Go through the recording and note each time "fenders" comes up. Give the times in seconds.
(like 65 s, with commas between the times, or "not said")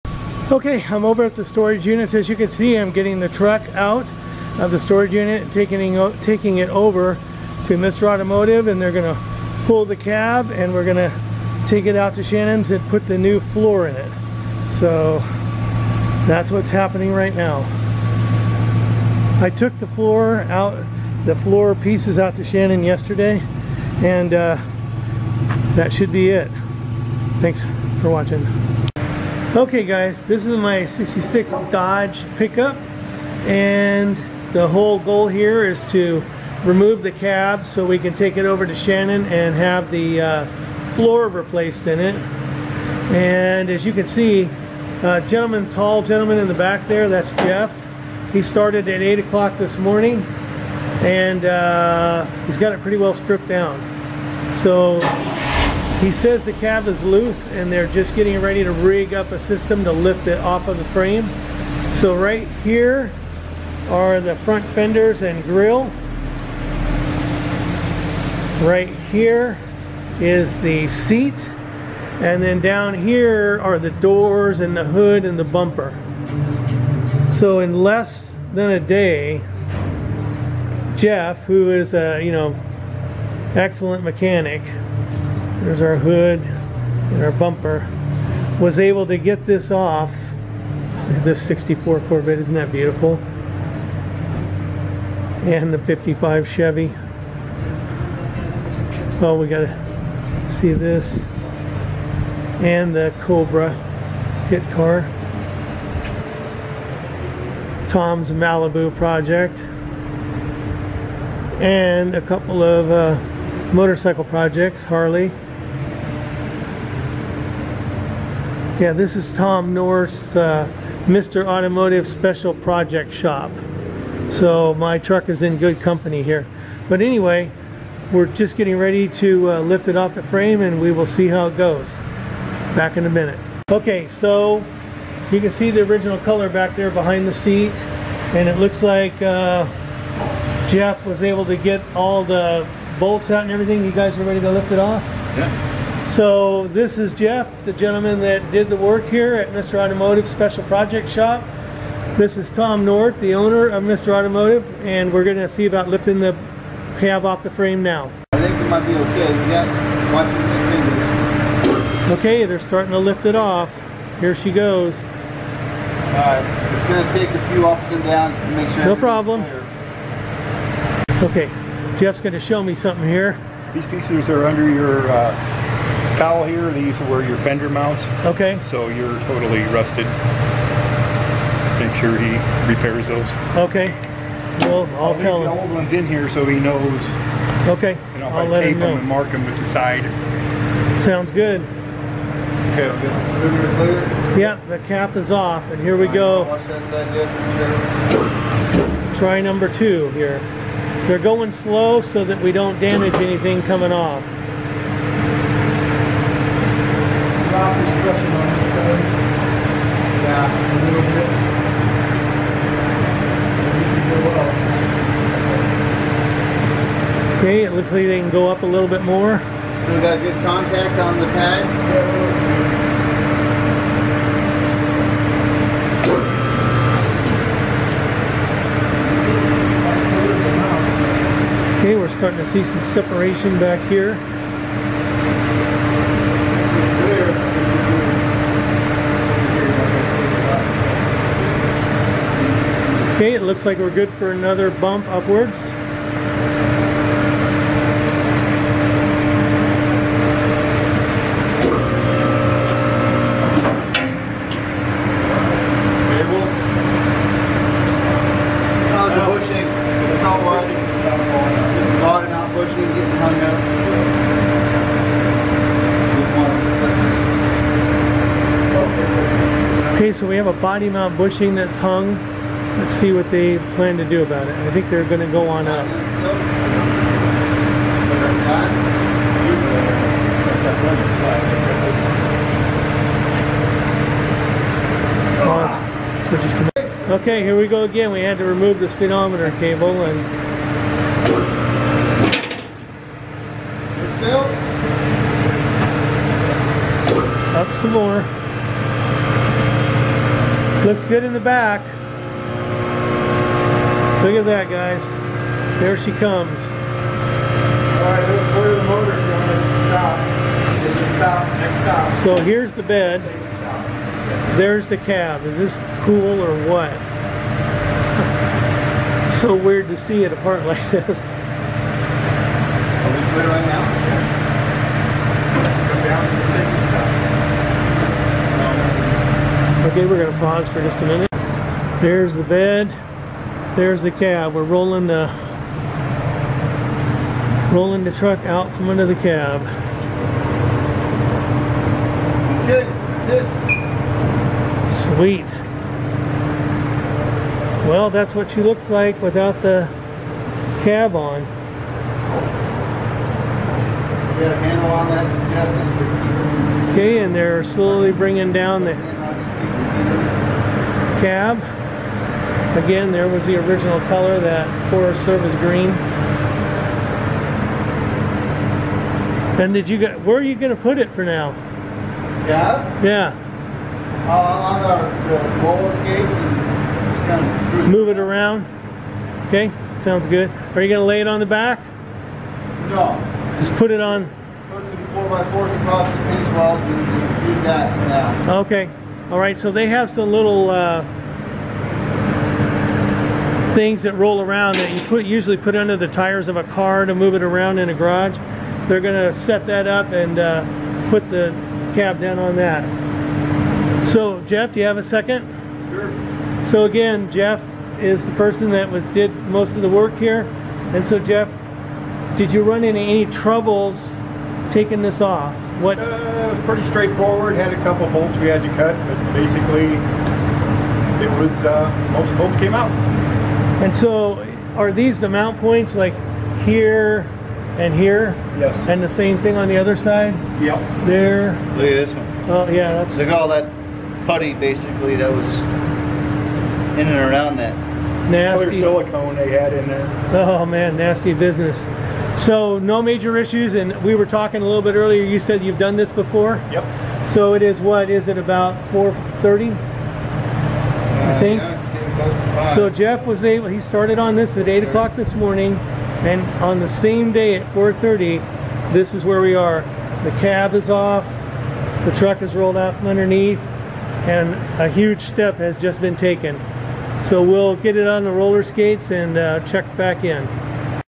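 64 s, 177 s.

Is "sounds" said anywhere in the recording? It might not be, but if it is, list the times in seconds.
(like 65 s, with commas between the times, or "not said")
191 s, 380 s.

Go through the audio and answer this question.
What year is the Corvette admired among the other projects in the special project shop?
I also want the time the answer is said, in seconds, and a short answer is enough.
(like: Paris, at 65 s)
1964, at 91 s.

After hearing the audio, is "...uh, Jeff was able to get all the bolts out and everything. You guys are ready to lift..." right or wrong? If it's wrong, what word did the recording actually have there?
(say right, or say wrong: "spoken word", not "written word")
right.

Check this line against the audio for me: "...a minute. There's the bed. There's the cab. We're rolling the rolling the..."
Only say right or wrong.
right.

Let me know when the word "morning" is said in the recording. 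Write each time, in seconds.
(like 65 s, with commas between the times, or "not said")
49 s, 455 s.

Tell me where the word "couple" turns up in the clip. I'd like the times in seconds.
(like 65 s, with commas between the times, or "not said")
112 s, 417 s.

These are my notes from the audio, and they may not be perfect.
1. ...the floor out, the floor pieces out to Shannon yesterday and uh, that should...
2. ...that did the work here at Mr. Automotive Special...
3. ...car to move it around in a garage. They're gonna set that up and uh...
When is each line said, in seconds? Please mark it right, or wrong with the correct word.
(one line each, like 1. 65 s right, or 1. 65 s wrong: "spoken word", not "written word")
1. 19 s right
2. 148 s right
3. 396 s right.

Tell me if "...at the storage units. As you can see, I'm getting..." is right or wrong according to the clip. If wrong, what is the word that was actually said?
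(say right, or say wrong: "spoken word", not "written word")
right.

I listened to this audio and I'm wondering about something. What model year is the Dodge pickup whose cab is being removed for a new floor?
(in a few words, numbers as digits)
1966.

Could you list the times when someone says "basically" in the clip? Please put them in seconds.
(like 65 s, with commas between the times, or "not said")
419 s, 434 s.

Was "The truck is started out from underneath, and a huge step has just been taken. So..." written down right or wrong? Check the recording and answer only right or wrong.
wrong.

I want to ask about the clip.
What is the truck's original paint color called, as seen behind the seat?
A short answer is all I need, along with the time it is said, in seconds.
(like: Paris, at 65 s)
Forest Service green, at 364 s.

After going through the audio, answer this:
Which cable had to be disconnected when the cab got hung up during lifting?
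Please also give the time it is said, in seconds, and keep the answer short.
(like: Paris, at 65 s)
speedometer cable, at 288 s.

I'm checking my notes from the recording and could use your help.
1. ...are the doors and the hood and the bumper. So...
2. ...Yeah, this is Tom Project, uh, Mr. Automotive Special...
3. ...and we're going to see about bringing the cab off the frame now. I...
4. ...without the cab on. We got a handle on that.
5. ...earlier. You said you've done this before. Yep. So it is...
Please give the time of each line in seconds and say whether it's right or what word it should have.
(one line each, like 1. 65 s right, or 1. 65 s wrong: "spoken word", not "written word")
1. 73 s right
2. 118 s wrong: "North", not "Project"
3. 154 s wrong: "lifting", not "bringing"
4. 349 s right
5. 444 s right.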